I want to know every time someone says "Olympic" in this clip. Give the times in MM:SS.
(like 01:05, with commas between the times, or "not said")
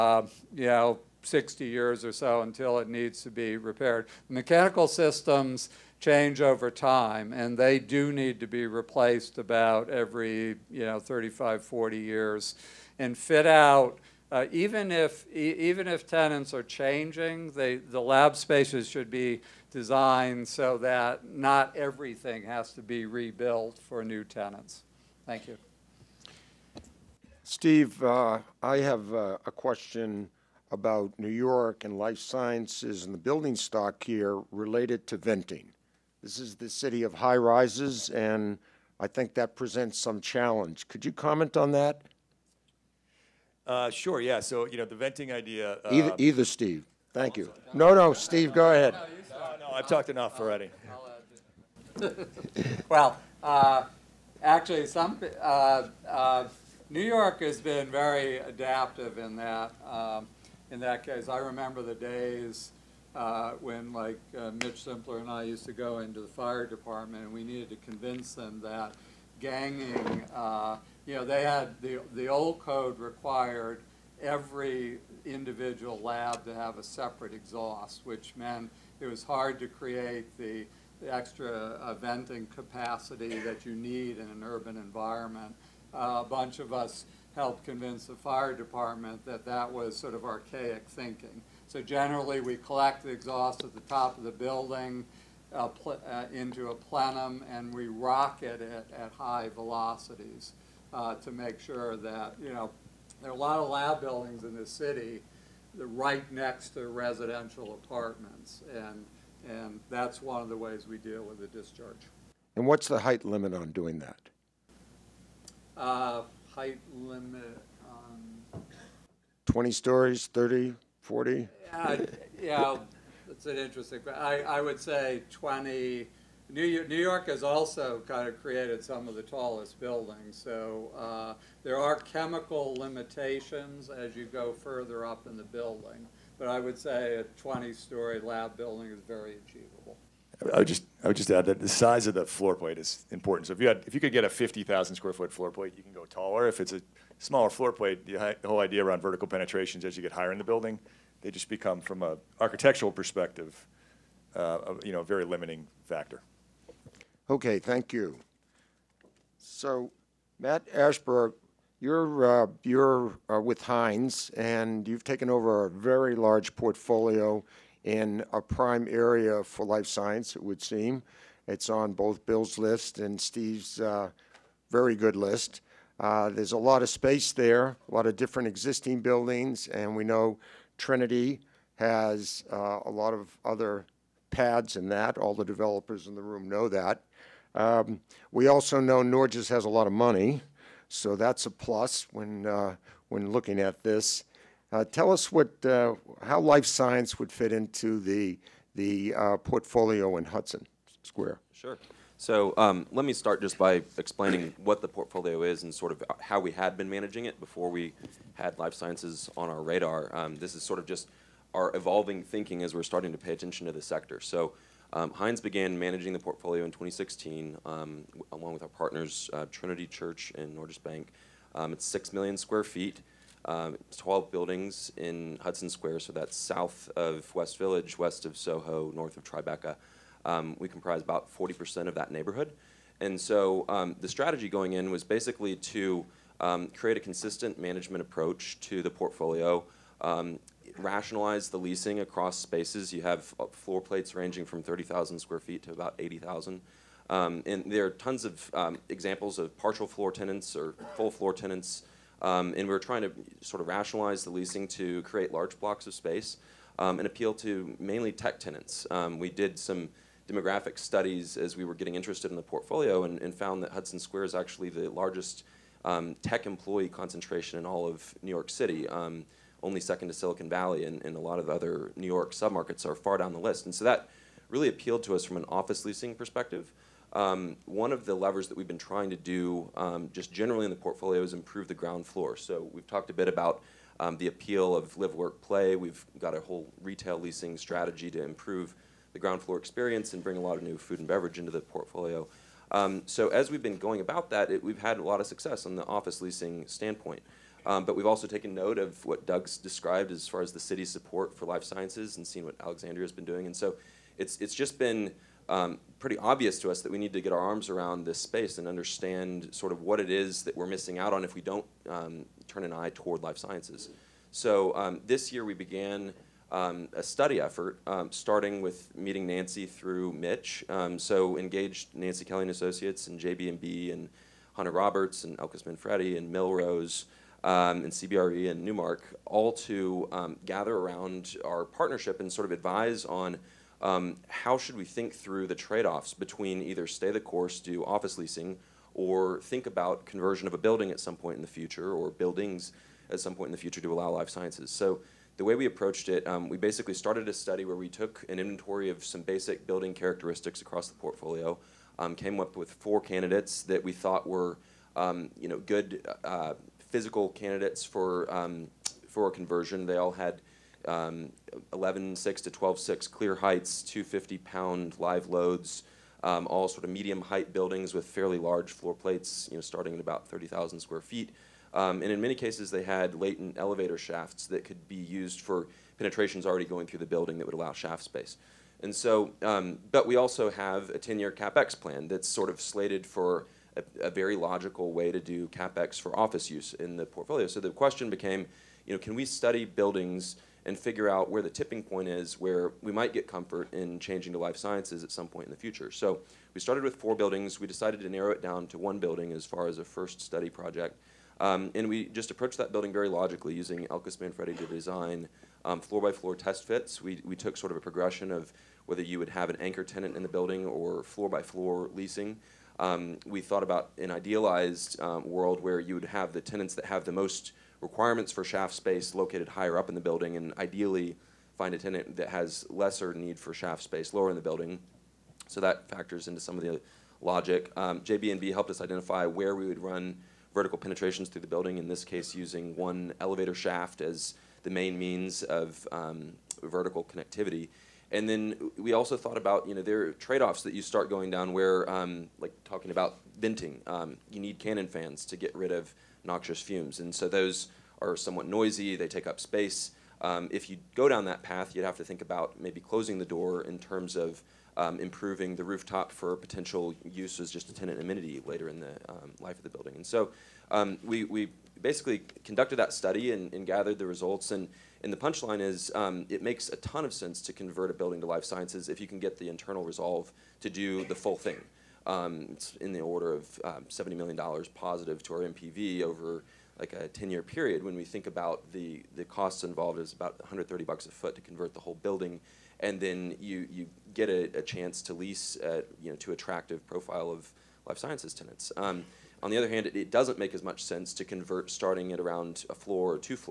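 not said.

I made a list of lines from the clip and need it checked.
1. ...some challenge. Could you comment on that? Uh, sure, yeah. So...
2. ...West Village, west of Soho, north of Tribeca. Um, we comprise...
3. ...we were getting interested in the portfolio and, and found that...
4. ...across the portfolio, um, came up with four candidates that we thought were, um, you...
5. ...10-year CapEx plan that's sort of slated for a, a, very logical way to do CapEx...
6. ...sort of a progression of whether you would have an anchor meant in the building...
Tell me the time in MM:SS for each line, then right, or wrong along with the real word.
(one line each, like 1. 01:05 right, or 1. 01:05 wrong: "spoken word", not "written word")
1. 00:39 right
2. 03:47 right
3. 04:21 right
4. 05:50 right
5. 06:20 right
6. 06:47 wrong: "tenant", not "meant".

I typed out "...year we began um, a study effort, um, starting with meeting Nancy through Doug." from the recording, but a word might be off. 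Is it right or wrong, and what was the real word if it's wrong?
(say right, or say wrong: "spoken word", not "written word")
wrong: "Mitch", not "Doug".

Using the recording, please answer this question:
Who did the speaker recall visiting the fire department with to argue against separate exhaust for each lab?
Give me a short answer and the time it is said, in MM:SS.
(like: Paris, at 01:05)
Mitch Simpler, at 01:04.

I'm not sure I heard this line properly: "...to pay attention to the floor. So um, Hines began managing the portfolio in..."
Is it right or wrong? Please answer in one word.
wrong.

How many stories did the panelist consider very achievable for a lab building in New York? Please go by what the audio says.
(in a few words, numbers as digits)
20.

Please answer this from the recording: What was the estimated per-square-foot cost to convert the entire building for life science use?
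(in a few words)
$130 per foot.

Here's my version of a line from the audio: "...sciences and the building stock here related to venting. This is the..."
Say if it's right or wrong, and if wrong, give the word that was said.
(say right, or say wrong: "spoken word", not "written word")
right.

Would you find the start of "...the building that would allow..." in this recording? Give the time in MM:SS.
06:16.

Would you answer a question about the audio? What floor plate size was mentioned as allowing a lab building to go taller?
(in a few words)
50,000 square feet.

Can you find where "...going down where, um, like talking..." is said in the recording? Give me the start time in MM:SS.
07:21.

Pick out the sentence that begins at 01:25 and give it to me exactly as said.
Uh, a bunch of us helped convince the fire department that that was sort of archaic thinking.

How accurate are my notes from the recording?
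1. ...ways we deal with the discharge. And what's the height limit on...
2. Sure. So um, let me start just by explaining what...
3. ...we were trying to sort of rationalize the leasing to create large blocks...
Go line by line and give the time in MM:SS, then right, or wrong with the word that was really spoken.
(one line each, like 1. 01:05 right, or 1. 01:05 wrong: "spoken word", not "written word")
1. 01:50 right
2. 03:21 right
3. 04:12 right.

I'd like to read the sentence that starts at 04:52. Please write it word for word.
Um, so as we've been going about that, it, we've had a lot of success on the office leasing standpoint.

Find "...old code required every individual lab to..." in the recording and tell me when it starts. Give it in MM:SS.
01:12.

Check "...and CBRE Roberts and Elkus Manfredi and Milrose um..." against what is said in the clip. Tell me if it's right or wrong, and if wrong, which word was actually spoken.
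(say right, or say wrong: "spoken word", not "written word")
wrong: "Hunter", not "CBRE".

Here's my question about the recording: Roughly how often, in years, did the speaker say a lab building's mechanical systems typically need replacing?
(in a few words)
35 to 40 years.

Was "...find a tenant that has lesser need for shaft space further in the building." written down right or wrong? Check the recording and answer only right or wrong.
wrong.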